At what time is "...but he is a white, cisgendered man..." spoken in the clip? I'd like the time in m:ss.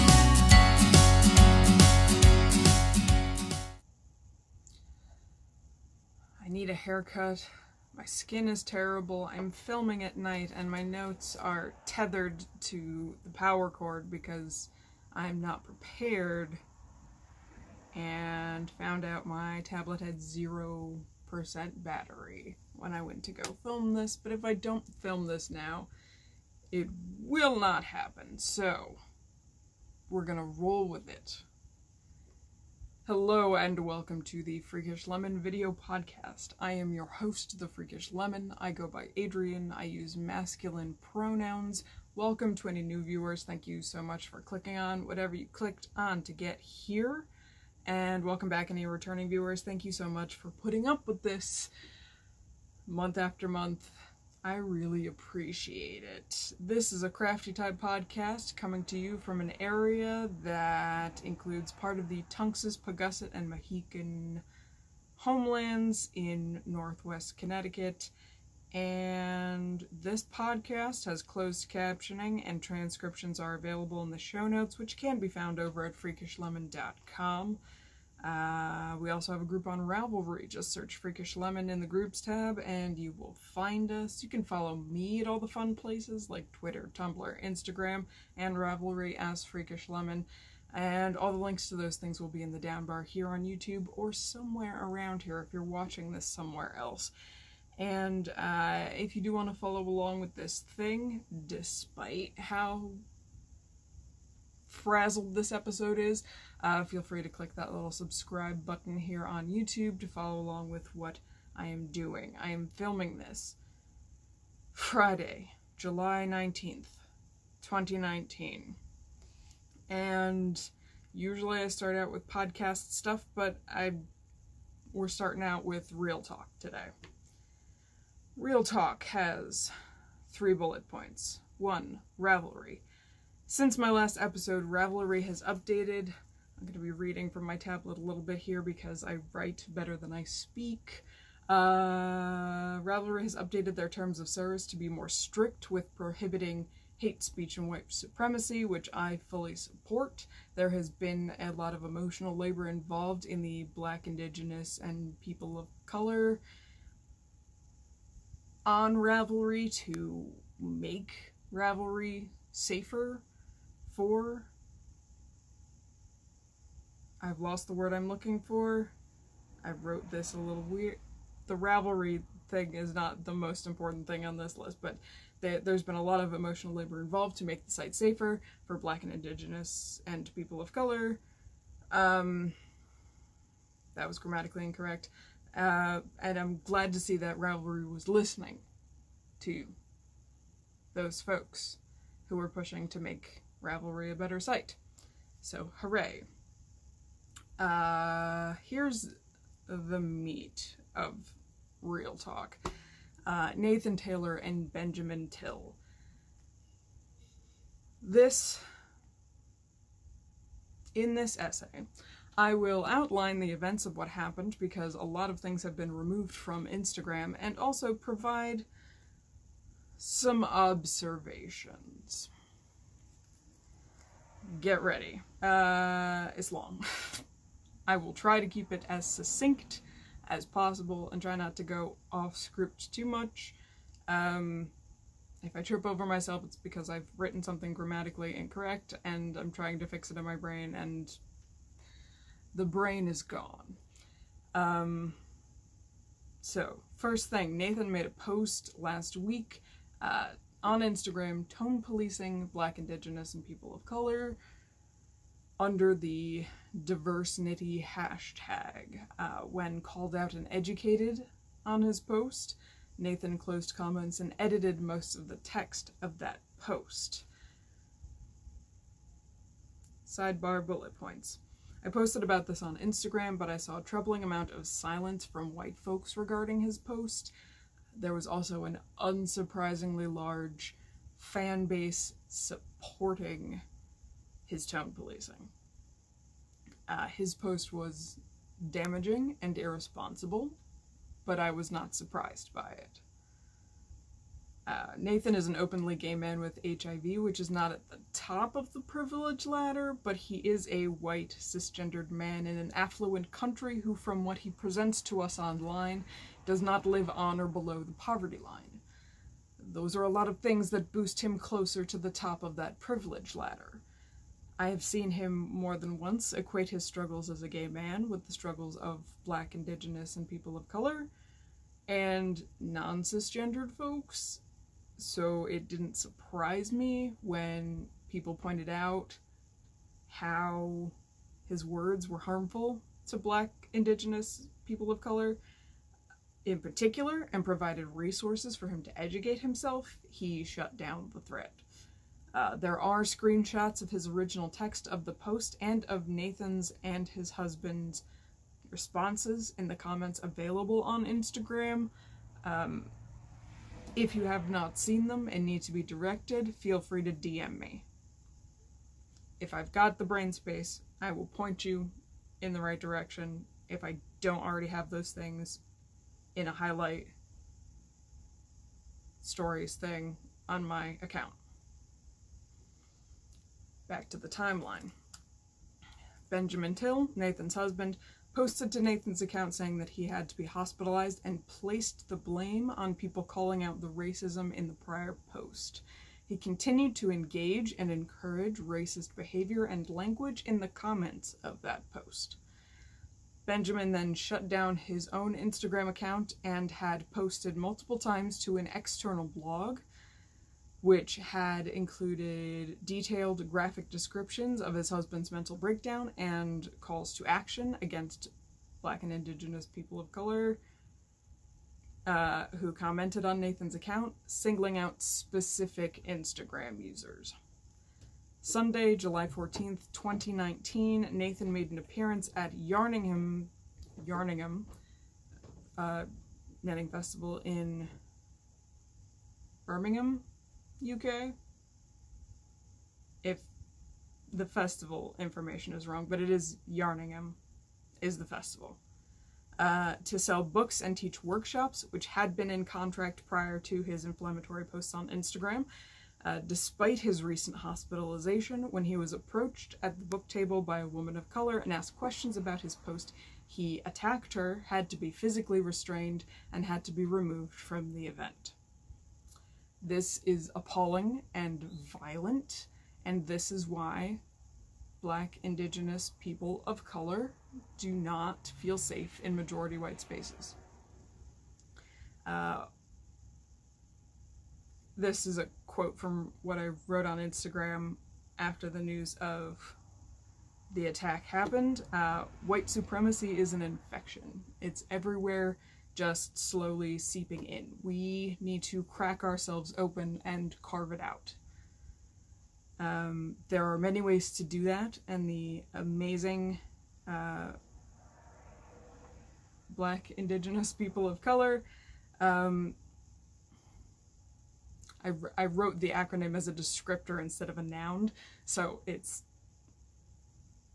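5:00.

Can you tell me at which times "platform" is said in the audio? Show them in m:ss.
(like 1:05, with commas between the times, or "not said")
not said.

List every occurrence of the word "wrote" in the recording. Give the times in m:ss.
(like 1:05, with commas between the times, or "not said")
2:49, 7:56, 8:25.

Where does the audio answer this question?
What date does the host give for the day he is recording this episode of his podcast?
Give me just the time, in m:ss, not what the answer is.
1:55.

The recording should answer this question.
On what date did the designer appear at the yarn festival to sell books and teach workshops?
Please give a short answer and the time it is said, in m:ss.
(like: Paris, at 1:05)
Sunday, July 14th, at 6:58.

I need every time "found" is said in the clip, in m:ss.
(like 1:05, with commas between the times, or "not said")
0:18, 1:15.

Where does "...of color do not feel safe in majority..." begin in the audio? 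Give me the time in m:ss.
7:46.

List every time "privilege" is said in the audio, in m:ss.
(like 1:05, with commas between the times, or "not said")
4:58, 5:12.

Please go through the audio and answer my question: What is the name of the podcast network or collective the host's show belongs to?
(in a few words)
Crafty Tide.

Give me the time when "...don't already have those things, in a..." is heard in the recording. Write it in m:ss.
6:04.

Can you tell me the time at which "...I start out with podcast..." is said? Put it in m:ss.
2:01.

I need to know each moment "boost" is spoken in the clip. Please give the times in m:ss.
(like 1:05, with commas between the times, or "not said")
5:10.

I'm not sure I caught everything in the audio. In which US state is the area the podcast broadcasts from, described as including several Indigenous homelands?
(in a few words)
Connecticut.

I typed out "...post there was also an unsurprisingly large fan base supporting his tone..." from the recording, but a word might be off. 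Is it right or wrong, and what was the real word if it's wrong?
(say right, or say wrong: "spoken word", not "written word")
right.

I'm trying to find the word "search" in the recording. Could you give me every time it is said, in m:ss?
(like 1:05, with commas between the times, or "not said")
1:20.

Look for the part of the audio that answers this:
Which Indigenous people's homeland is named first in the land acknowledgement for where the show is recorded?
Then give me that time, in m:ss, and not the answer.
1:02.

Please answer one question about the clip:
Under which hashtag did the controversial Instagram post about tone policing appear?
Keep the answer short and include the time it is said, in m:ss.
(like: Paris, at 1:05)
DiversKnitty, at 4:16.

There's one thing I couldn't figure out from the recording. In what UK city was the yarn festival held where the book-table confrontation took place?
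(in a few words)
Birmingham.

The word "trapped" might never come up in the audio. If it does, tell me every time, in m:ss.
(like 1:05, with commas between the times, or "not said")
not said.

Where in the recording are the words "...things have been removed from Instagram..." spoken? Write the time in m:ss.
3:35.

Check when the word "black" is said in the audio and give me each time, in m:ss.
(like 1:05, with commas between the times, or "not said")
2:33, 2:58, 4:12, 5:19, 5:33, 6:48, 7:44, 8:19.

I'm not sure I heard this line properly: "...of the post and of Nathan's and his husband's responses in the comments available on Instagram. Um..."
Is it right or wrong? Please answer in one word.
right.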